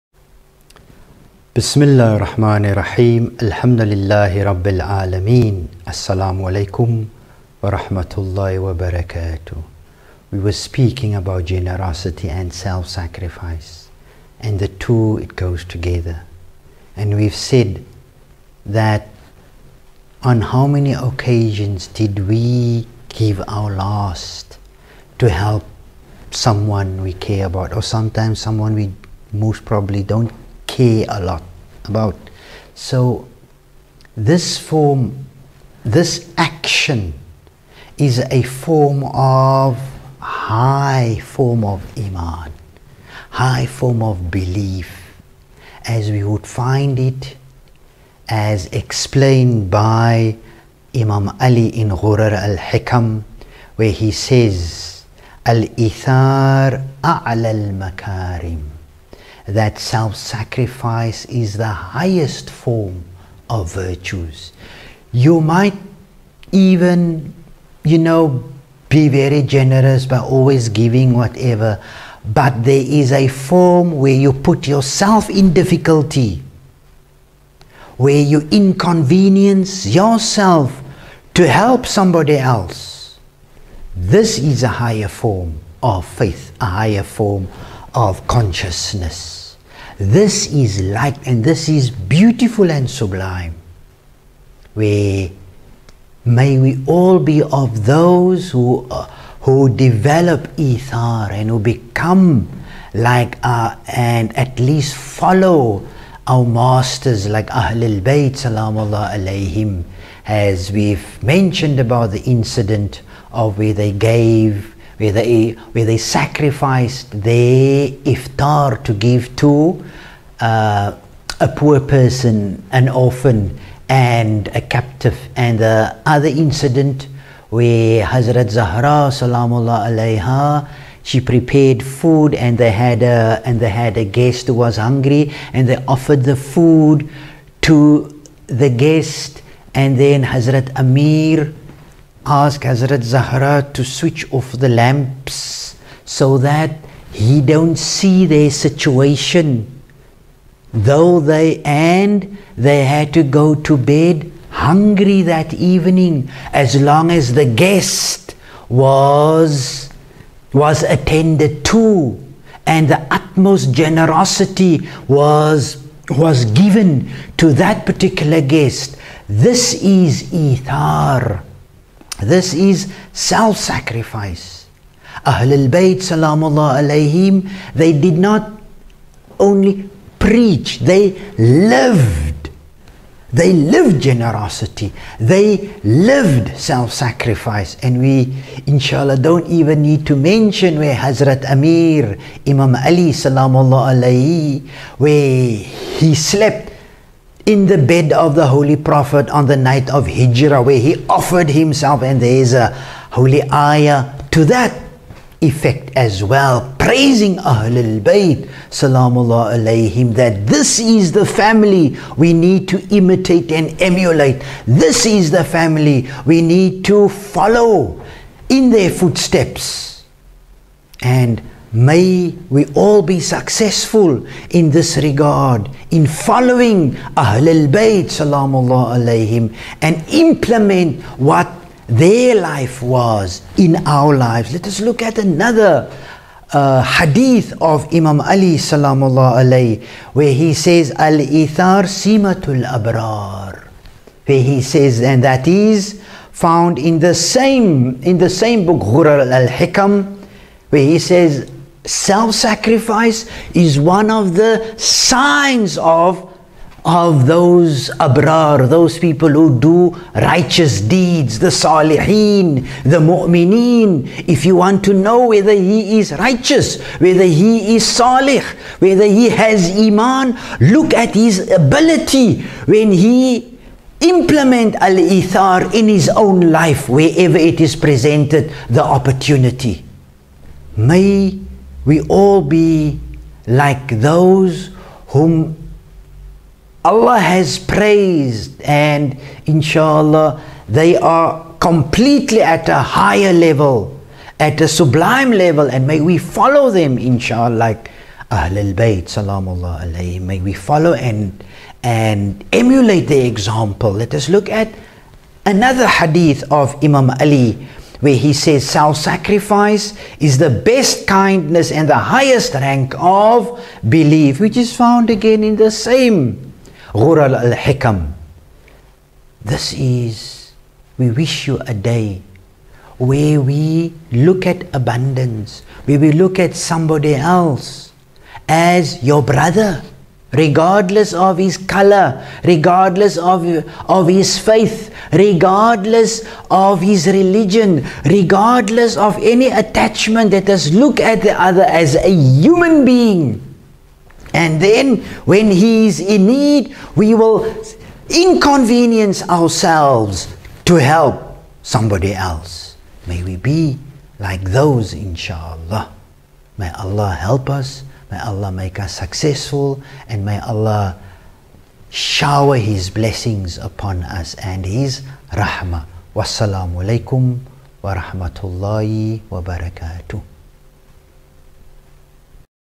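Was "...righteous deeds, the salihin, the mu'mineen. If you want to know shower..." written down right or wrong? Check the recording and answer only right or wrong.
wrong.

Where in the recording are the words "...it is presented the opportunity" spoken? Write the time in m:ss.
4:37.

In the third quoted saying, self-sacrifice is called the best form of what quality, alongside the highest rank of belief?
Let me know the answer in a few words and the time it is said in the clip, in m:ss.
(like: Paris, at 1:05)
kindness, at 5:11.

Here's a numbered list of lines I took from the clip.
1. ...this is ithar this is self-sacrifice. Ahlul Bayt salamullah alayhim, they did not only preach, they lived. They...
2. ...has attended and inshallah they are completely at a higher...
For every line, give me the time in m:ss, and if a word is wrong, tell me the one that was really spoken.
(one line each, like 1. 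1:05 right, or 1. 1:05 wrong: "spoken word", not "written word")
1. 2:49 right
2. 4:47 wrong: "praised", not "attended".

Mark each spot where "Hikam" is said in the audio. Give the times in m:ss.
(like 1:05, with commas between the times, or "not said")
0:52, 4:09, 5:17.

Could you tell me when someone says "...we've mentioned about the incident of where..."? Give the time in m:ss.
1:50.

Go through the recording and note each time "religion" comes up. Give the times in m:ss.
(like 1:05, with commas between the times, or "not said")
5:37.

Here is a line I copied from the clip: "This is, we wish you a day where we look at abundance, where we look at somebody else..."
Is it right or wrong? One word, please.
right.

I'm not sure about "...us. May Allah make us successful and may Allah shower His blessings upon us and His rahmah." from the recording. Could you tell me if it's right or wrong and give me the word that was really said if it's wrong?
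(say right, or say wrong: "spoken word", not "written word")
right.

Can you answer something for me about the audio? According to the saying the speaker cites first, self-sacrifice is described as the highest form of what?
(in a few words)
virtues.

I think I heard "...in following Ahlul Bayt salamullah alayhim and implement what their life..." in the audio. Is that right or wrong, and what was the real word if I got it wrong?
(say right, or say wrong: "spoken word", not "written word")
right.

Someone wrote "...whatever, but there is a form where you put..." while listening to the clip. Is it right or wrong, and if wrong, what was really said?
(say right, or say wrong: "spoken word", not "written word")
right.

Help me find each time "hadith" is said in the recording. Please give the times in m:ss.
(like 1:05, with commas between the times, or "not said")
3:56, 5:05.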